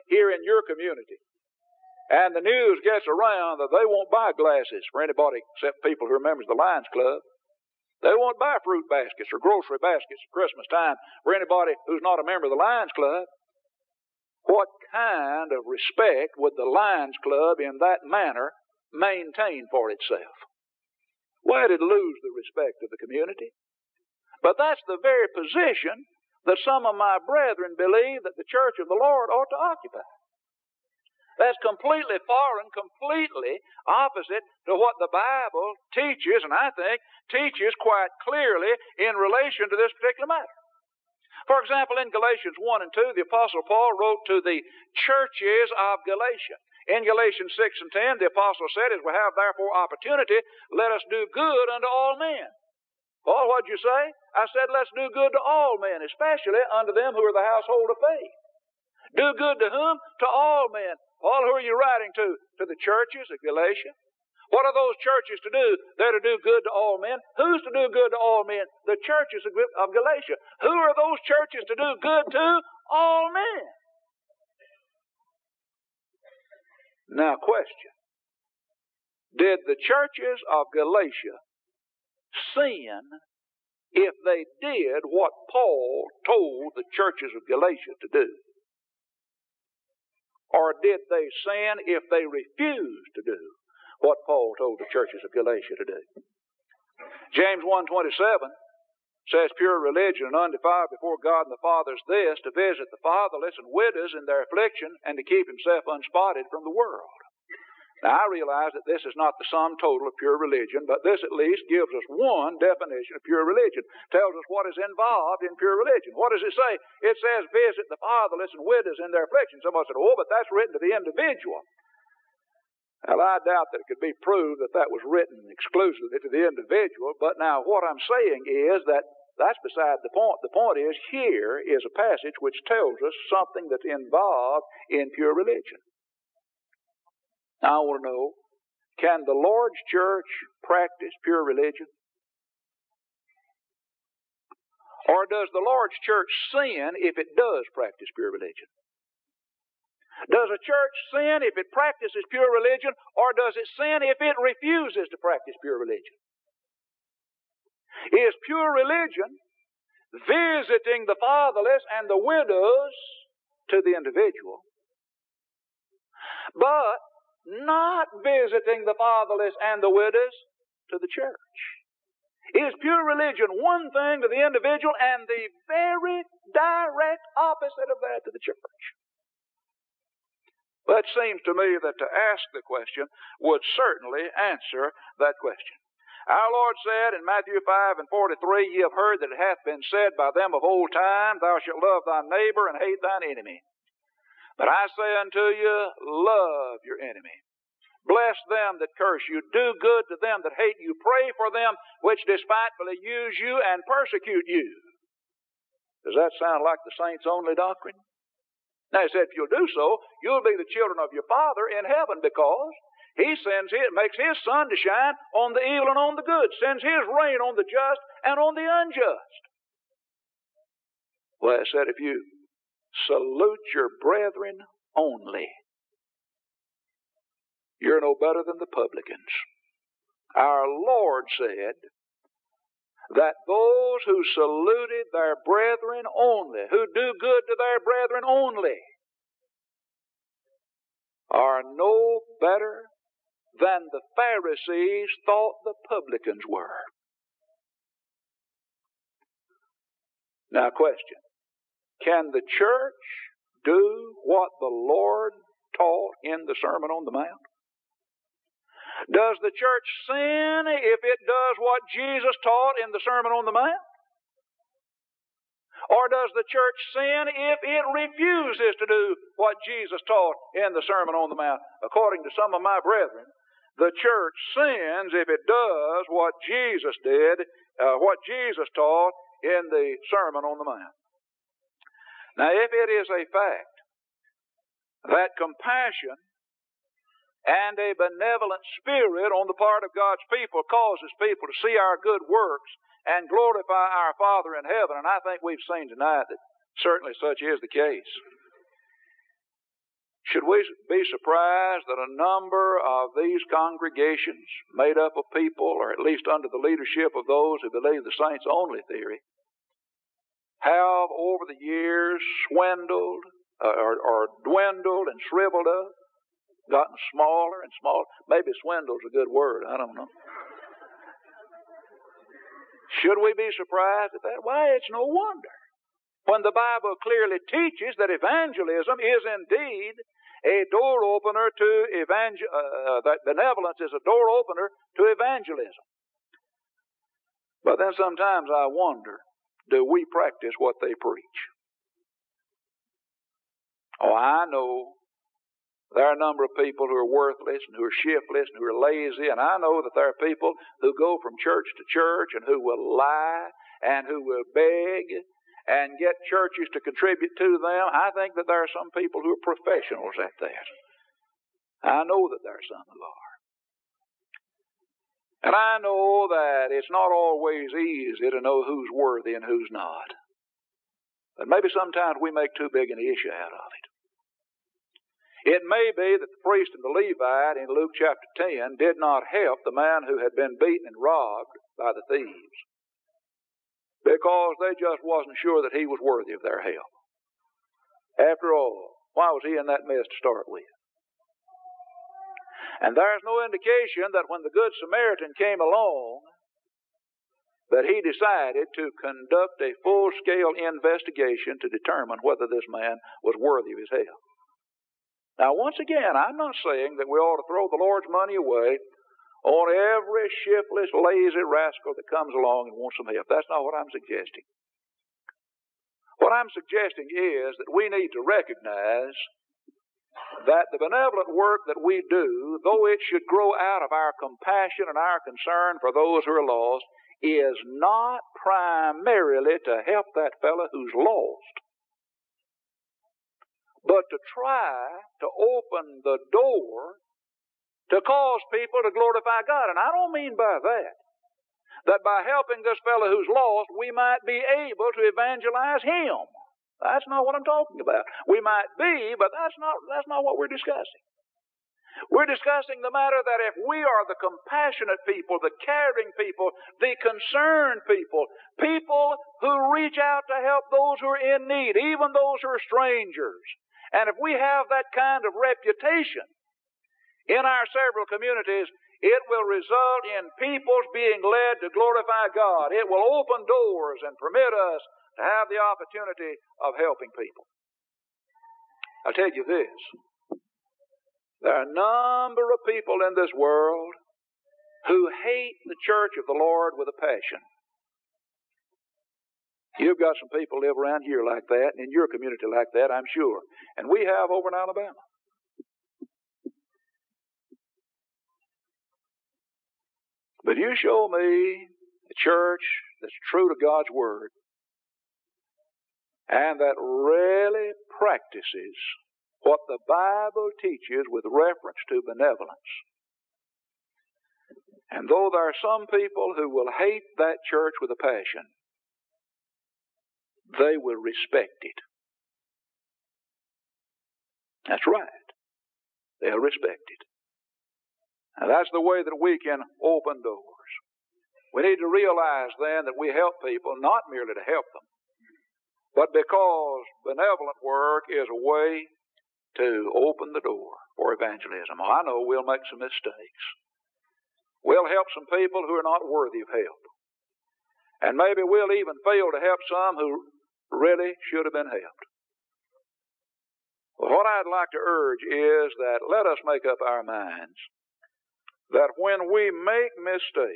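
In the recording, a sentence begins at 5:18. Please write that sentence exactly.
Maybe swindle's a good word, I don't know.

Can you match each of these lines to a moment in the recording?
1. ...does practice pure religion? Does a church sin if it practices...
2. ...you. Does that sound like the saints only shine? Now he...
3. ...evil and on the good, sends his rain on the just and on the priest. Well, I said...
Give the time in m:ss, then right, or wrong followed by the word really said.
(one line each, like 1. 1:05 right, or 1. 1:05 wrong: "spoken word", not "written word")
1. 2:27 right
2. 3:24 wrong: "doctrine", not "shine"
3. 3:35 wrong: "unjust", not "priest".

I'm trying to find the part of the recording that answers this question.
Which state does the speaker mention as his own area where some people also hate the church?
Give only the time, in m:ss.
8:14.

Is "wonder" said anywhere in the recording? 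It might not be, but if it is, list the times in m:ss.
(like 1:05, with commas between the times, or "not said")
5:25, 5:38.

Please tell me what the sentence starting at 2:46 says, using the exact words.
But not visiting the fatherless and the widows to the church.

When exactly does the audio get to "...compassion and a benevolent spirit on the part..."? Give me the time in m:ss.
4:45.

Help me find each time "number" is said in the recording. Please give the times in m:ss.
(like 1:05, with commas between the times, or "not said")
5:02, 5:46, 8:01.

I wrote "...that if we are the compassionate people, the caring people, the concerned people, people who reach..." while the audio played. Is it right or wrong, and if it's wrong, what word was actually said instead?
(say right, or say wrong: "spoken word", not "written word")
right.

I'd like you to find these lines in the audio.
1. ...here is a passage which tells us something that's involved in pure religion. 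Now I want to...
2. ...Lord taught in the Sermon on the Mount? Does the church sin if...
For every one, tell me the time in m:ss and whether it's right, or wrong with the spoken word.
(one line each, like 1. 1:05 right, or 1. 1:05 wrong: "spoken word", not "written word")
1. 2:11 right
2. 4:14 right.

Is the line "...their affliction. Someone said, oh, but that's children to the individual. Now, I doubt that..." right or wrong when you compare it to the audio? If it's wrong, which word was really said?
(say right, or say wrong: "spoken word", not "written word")
wrong: "written", not "children".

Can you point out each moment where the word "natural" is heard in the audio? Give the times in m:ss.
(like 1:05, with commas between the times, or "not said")
not said.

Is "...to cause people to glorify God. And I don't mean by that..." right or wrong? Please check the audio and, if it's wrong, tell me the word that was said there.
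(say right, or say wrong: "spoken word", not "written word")
right.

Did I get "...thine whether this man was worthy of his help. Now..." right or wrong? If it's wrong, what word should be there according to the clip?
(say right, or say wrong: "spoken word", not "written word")
wrong: "determine", not "thine".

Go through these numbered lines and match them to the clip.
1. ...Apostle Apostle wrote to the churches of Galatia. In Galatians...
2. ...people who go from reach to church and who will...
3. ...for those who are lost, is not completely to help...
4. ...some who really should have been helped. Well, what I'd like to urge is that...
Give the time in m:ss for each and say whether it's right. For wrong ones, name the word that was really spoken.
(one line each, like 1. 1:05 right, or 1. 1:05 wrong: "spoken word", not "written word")
1. 0:43 wrong: "Paul", not "Apostle"
2. 5:50 wrong: "church", not "reach"
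3. 7:05 wrong: "primarily", not "completely"
4. 9:09 right.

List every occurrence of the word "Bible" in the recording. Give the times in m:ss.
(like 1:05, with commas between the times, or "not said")
0:35, 5:26, 8:29.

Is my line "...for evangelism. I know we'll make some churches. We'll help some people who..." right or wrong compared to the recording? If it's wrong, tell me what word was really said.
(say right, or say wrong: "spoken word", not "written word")
wrong: "mistakes", not "churches".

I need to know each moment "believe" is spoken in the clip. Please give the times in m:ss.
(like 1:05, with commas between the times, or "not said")
0:27, 5:07.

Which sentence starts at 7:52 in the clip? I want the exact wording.
It will open doors and permit us to have the opportunity of helping people.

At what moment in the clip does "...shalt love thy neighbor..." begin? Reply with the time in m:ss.
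3:11.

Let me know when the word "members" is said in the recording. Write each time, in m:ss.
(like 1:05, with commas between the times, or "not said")
0:06, 0:12.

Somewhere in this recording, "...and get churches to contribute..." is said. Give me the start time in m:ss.
5:55.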